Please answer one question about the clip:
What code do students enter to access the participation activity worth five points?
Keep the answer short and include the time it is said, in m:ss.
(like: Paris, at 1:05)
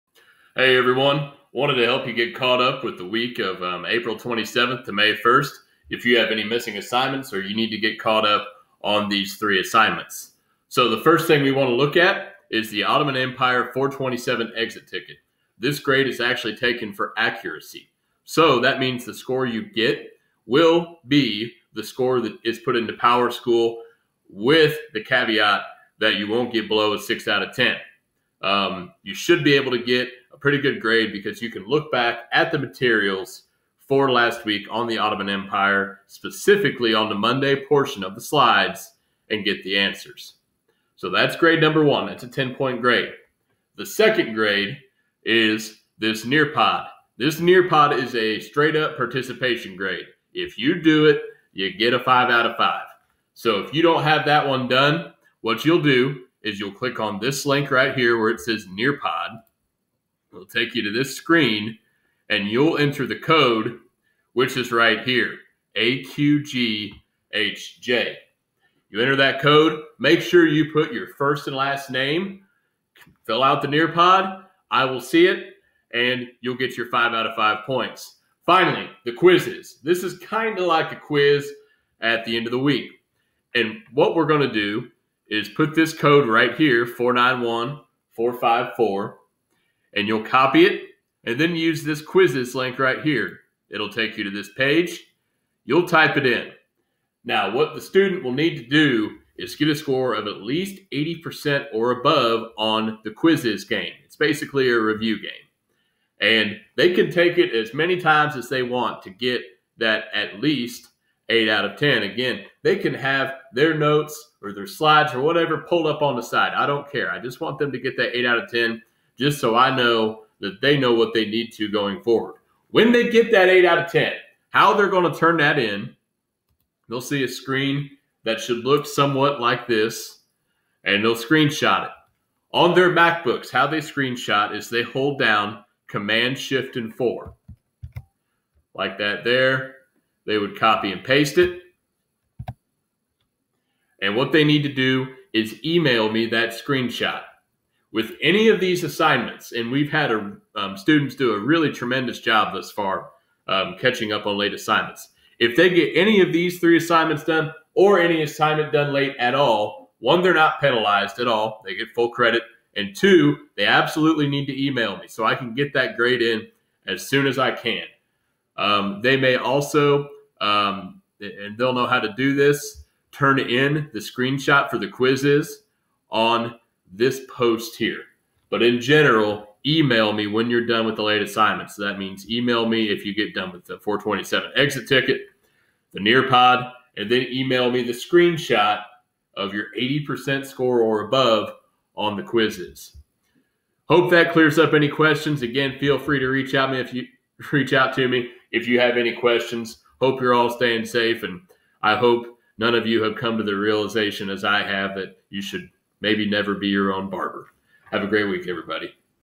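AQGHJ, at 1:05.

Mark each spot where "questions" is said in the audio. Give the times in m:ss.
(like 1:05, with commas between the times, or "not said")
3:14, 3:19.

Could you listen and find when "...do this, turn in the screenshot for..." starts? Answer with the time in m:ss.
2:52.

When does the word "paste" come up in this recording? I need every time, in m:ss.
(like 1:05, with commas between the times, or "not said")
2:21.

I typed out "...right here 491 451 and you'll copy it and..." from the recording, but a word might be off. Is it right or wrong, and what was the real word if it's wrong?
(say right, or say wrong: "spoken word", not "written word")
wrong: "454", not "451".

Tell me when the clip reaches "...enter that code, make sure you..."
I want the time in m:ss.
1:09.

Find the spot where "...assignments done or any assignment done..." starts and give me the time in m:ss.
2:36.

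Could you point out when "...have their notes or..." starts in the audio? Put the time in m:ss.
1:52.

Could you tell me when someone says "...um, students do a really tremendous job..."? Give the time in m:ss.
2:30.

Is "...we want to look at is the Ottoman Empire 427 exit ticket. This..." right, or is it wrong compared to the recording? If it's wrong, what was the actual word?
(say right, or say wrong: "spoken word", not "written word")
right.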